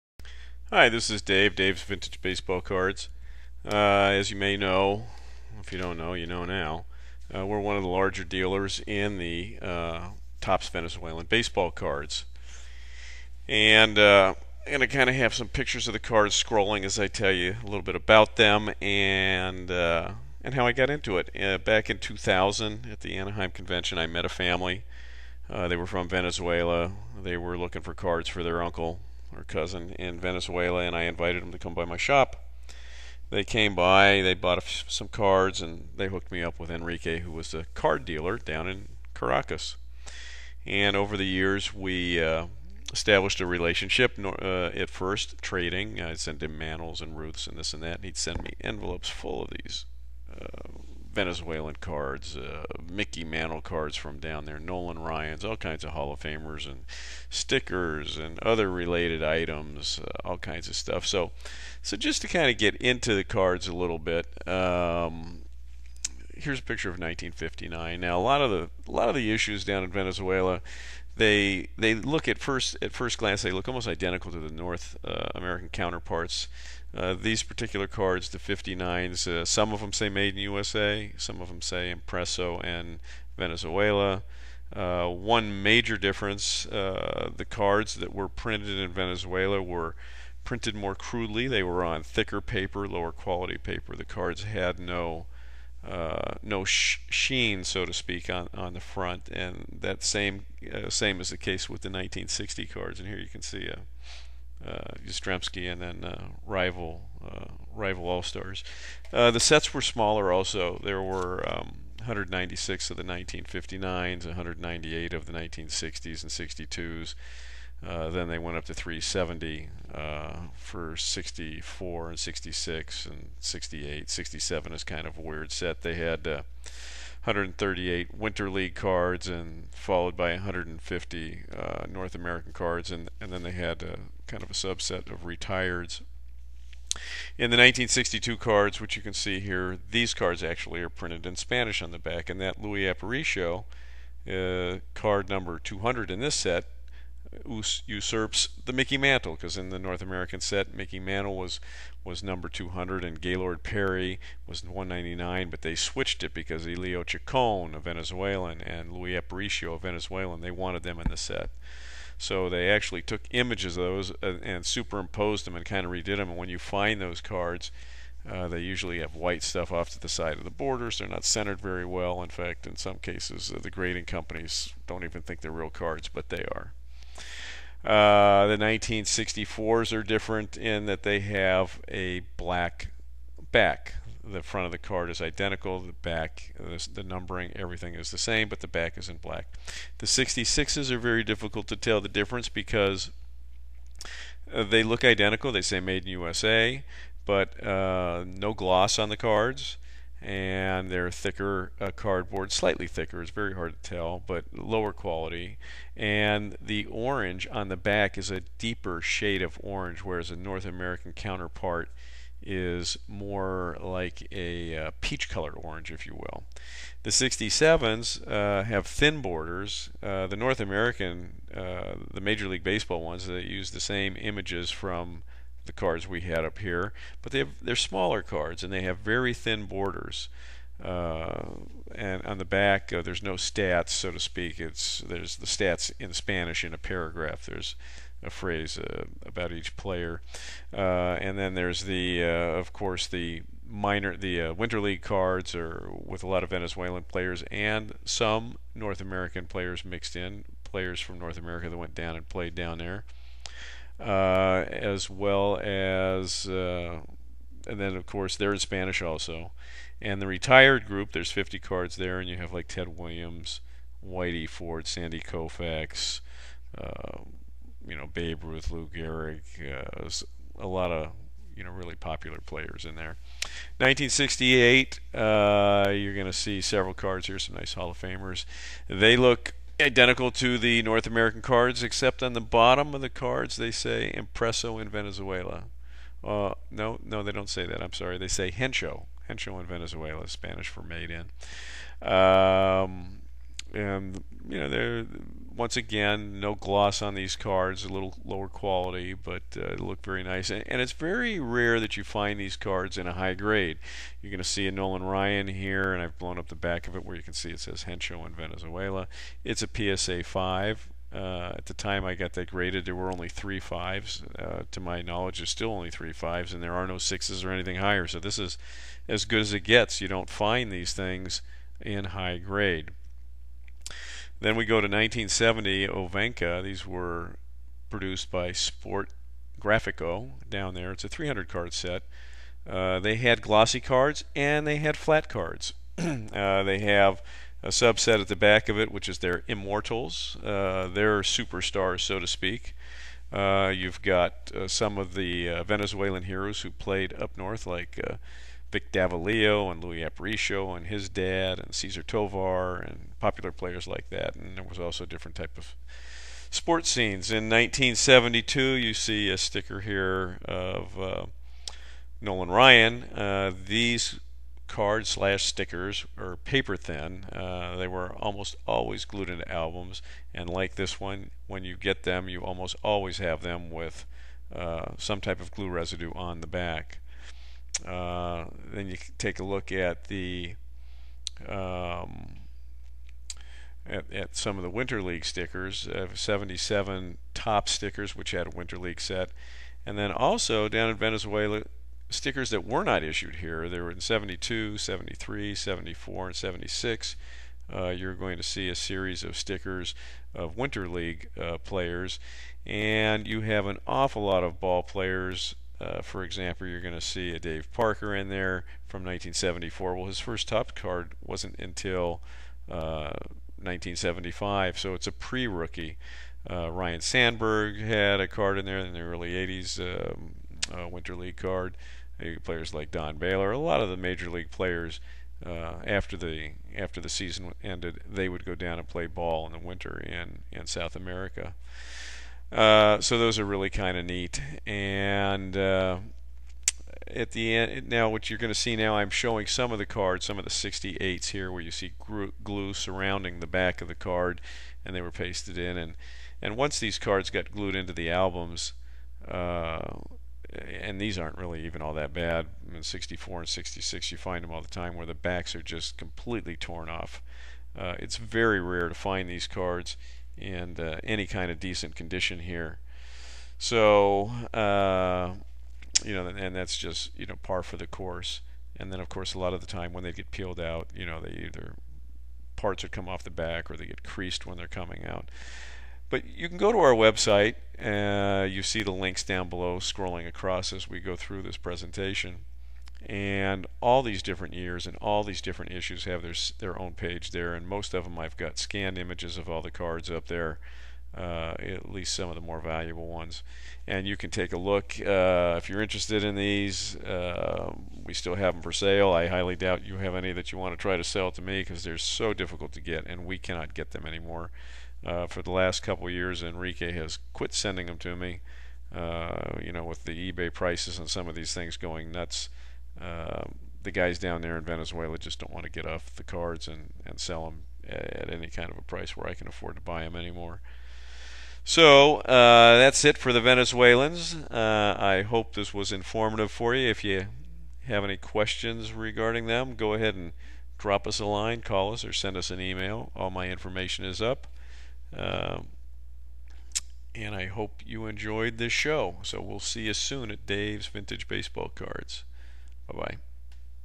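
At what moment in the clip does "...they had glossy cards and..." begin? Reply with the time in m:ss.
5:32.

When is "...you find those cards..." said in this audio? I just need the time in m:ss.
2:46.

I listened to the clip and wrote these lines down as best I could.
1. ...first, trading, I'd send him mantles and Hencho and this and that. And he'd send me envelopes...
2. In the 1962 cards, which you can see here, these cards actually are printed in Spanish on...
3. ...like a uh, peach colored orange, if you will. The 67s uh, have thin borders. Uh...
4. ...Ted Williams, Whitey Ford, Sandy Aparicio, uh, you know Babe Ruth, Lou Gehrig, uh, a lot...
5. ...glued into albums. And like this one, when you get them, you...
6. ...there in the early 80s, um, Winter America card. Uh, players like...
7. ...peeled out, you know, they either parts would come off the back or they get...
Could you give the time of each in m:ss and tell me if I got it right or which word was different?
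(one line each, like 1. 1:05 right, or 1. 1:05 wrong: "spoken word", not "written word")
1. 0:44 wrong: "Ruths", not "Hencho"
2. 2:17 right
3. 3:33 right
4. 4:22 wrong: "Koufax", not "Aparicio"
5. 6:09 right
6. 6:58 wrong: "League", not "America"
7. 7:50 right.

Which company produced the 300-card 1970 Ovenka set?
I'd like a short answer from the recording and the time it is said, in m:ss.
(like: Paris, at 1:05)
Sport Grafico, at 5:28.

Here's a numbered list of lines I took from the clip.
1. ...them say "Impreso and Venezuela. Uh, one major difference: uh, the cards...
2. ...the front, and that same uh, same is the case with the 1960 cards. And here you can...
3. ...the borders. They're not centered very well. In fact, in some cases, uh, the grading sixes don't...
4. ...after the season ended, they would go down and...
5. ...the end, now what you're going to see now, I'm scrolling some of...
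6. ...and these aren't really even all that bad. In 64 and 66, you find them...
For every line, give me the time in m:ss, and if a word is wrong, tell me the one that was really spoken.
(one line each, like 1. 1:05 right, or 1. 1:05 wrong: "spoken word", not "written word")
1. 1:21 right
2. 1:38 right
3. 2:50 wrong: "companies", not "sixes"
4. 7:06 right
5. 7:17 wrong: "showing", not "scrolling"
6. 7:30 right.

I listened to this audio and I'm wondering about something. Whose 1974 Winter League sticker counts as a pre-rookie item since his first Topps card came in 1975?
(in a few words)
Dave Parker.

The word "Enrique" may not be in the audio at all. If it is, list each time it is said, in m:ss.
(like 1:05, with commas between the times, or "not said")
0:36, 8:26.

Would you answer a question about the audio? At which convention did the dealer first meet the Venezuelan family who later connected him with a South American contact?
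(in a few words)
Anaheim Convention.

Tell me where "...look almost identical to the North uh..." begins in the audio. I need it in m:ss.
1:13.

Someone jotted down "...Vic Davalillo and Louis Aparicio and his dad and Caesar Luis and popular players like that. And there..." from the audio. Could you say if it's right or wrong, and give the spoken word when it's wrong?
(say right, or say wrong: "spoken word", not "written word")
wrong: "Tovar", not "Luis".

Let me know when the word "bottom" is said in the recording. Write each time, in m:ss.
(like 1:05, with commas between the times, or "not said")
4:42.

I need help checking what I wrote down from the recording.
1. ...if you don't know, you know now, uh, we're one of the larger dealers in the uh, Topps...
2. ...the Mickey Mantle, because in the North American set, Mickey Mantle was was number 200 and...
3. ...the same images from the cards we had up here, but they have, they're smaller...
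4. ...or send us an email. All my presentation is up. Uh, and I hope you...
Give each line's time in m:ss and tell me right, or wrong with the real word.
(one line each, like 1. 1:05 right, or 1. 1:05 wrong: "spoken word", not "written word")
1. 0:05 right
2. 2:28 right
3. 3:43 right
4. 8:52 wrong: "information", not "presentation".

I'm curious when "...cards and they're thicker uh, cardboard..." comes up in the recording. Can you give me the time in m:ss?
3:19.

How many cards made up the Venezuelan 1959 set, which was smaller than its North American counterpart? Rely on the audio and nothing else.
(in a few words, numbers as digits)
196.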